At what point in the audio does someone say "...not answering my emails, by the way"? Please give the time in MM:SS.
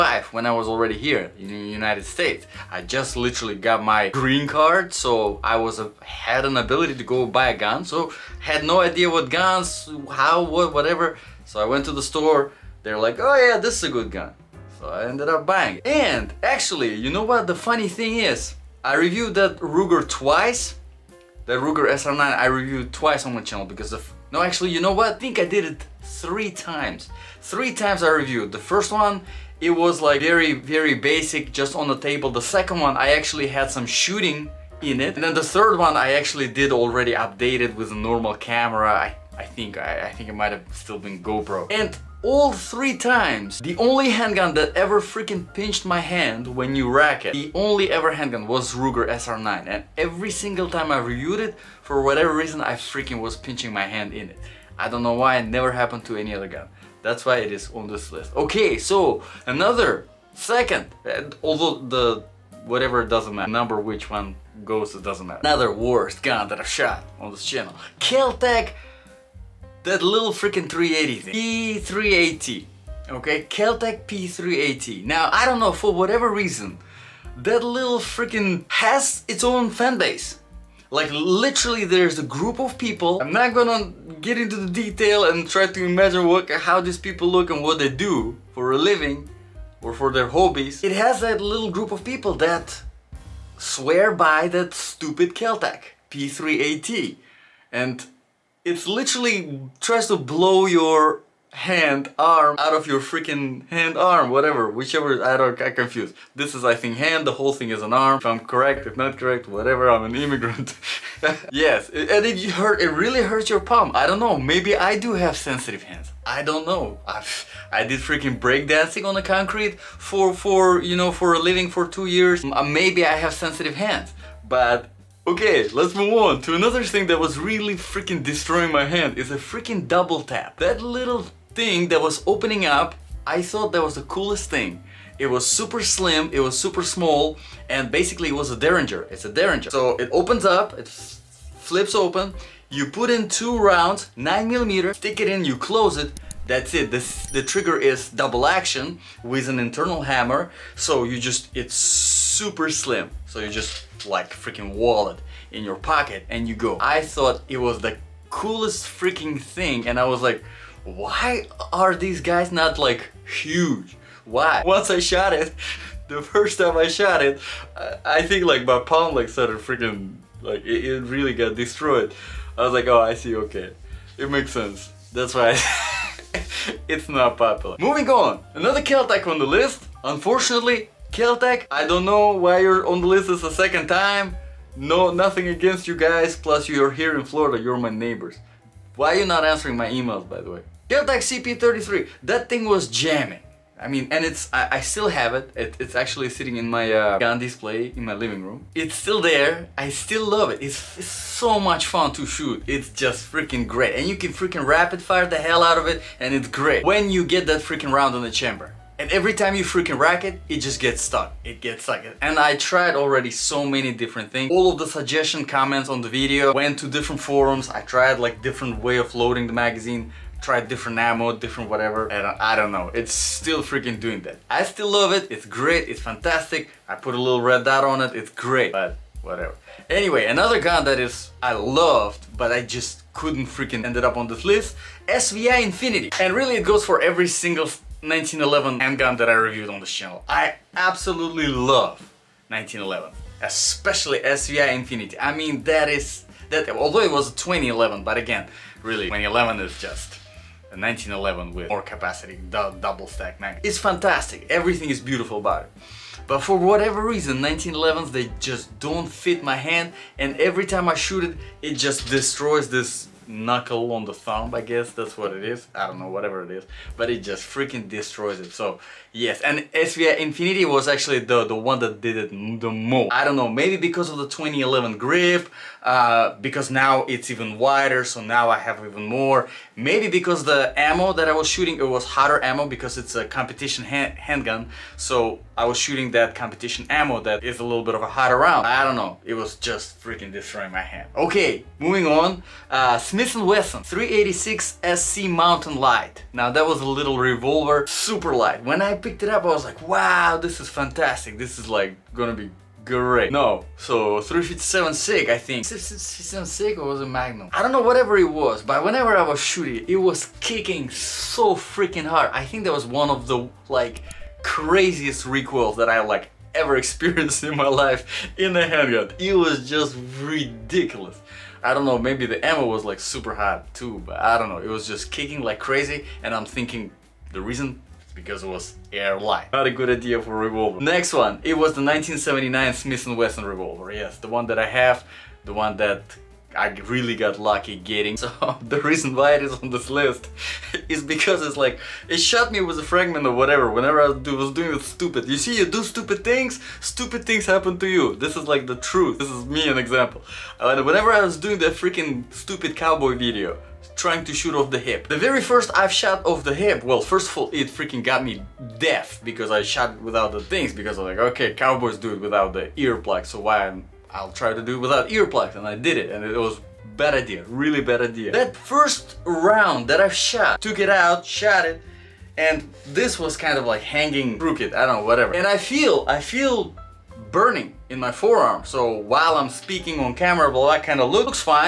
03:09.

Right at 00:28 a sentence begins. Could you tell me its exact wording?
The first one it was like very, very basic, just on the table.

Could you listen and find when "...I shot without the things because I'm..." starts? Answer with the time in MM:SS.
05:59.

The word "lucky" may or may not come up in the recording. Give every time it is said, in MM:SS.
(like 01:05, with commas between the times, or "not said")
05:37.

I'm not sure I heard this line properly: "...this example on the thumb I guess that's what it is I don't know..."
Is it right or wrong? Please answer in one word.
wrong.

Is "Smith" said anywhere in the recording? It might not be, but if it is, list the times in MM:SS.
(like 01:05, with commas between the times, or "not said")
04:53, 05:32.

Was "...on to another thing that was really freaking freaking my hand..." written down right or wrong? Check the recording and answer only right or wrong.
wrong.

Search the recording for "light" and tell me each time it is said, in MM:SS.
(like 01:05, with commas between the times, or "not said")
04:58, 05:29.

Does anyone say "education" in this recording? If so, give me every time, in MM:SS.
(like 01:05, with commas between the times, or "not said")
not said.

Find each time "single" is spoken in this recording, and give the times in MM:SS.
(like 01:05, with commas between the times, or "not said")
00:50, 03:57.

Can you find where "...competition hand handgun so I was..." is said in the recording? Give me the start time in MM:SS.
04:43.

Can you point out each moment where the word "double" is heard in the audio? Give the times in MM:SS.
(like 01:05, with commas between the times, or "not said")
02:09, 02:28, 04:12.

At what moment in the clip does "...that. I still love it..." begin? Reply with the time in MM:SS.
03:44.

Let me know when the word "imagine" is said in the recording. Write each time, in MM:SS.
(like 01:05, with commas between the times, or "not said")
01:25.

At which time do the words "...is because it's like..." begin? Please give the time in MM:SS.
05:40.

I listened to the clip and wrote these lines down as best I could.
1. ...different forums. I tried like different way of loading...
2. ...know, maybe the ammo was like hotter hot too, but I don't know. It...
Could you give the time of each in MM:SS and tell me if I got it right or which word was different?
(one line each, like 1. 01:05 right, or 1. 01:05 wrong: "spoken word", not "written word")
1. 03:36 right
2. 05:21 wrong: "super", not "hotter".